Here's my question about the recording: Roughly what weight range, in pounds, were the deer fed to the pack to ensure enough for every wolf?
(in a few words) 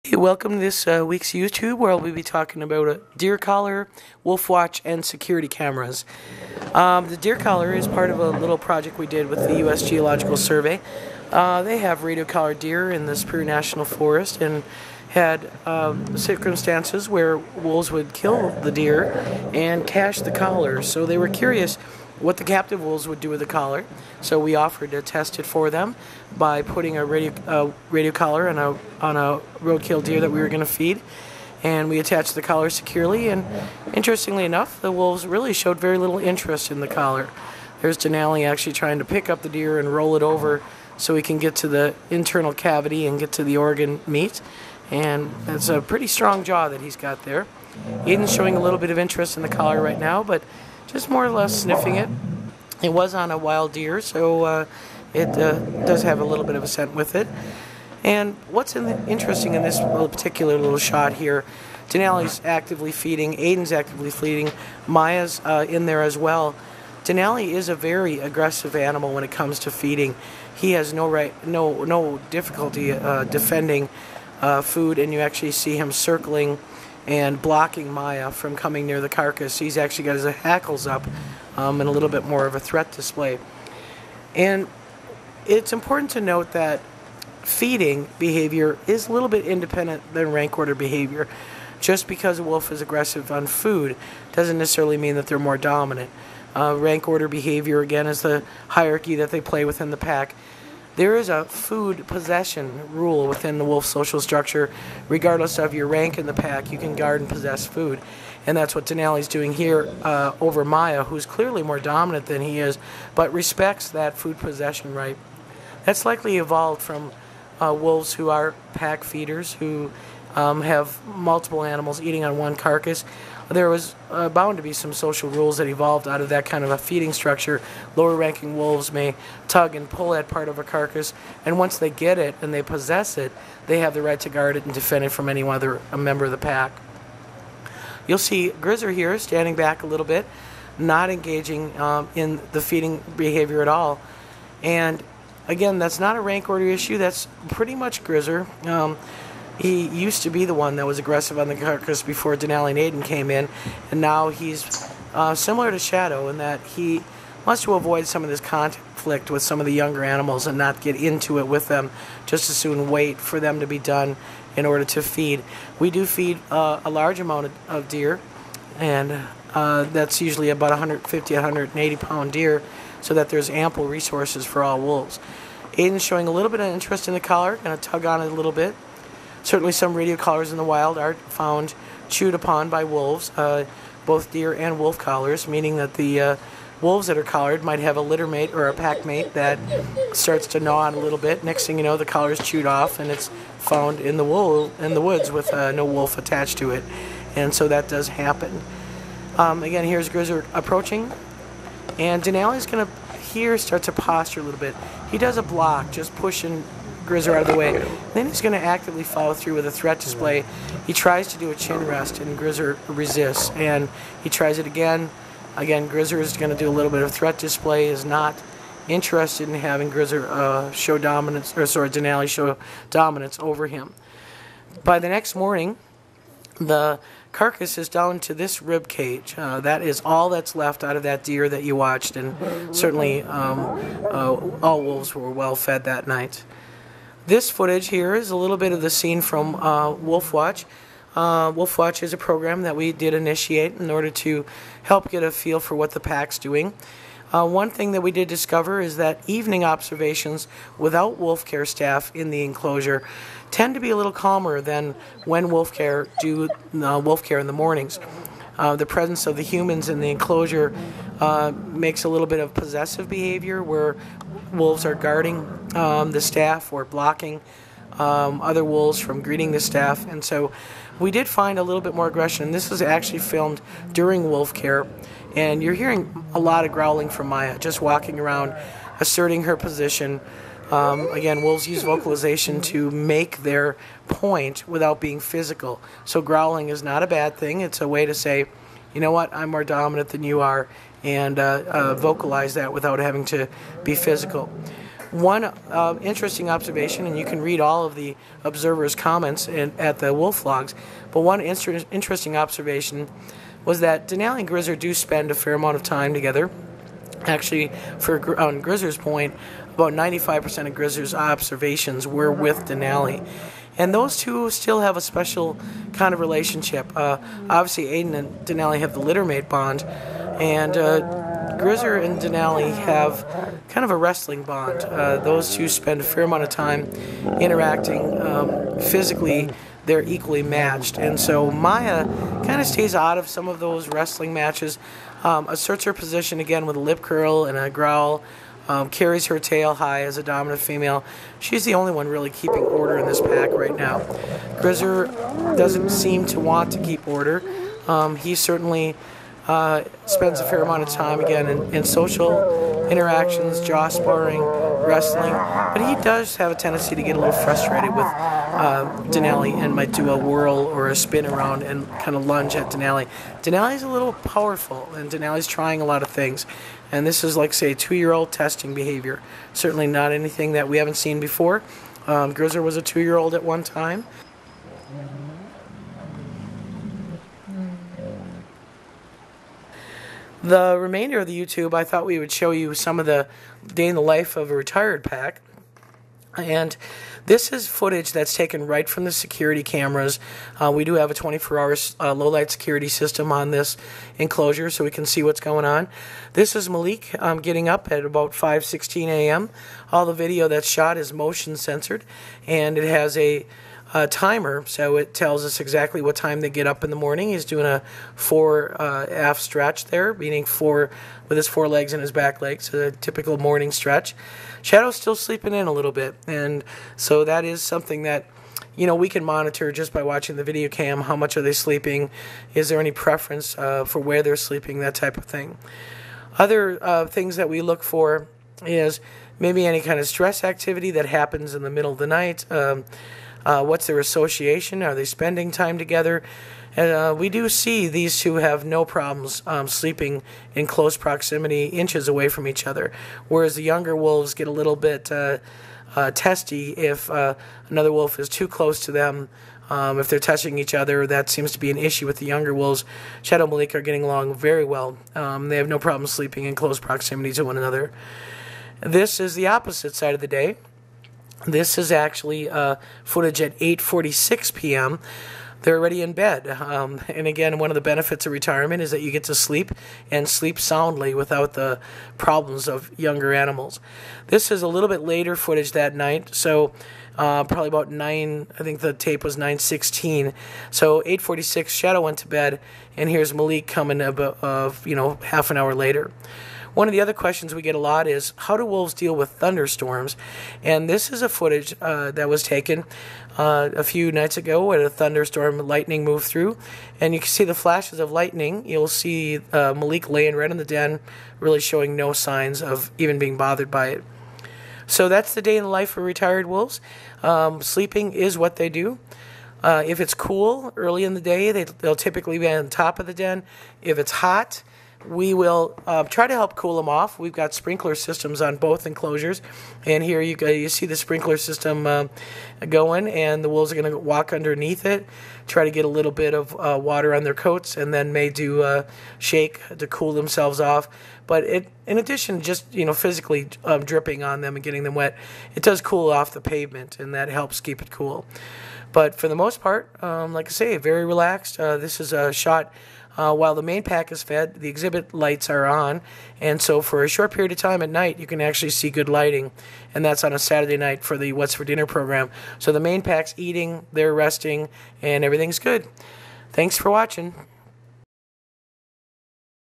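150-180 pounds.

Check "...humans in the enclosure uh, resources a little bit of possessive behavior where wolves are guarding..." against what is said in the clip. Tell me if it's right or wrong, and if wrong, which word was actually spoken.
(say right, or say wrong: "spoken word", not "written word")
wrong: "makes", not "resources".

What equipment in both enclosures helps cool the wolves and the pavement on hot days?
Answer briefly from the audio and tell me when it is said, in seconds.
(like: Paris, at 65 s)
Sprinkler systems, at 517 s.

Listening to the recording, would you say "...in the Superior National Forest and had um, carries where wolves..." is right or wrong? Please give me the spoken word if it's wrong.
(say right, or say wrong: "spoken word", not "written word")
wrong: "circumstances", not "carries".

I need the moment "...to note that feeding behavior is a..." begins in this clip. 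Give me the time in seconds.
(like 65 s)
86 s.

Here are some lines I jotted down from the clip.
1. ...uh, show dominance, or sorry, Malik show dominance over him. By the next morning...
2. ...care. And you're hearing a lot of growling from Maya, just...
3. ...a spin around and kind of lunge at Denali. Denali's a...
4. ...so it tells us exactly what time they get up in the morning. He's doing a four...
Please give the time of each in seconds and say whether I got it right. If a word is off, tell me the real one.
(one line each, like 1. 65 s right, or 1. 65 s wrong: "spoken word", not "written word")
1. 220 s wrong: "Denali", not "Malik"
2. 274 s right
3. 360 s right
4. 404 s right.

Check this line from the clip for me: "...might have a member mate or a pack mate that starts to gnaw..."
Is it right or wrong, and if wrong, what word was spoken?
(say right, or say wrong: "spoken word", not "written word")
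wrong: "litter", not "member".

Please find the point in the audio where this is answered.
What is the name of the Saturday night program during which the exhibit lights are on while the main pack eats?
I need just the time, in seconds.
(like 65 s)
551 s.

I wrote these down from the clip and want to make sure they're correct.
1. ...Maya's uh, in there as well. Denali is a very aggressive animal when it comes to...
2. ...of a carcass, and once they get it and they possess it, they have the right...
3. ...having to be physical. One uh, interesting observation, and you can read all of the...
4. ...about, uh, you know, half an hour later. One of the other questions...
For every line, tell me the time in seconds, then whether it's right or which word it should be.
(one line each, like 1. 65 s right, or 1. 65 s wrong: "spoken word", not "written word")
1. 64 s right
2. 130 s right
3. 292 s right
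4. 484 s right.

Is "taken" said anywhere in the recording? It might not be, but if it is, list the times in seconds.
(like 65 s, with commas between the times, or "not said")
388 s, 492 s.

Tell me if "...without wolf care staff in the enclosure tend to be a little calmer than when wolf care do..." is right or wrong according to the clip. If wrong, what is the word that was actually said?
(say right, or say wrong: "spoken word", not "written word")
right.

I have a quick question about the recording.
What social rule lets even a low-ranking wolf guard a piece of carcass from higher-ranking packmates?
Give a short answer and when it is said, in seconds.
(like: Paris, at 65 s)
Food possession rule, at 101 s.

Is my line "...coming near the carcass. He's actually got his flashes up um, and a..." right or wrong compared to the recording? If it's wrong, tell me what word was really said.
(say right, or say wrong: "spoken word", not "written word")
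wrong: "hackles", not "flashes".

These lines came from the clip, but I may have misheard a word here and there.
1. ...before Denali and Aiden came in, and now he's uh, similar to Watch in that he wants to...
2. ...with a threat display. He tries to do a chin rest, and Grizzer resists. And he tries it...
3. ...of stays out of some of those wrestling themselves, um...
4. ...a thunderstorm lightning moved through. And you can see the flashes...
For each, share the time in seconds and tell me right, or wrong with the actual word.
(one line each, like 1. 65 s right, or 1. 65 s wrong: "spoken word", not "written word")
1. 152 s wrong: "Shadow", not "Watch"
2. 209 s right
3. 332 s wrong: "matches", not "themselves"
4. 494 s right.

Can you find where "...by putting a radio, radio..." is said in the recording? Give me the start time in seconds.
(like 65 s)
26 s.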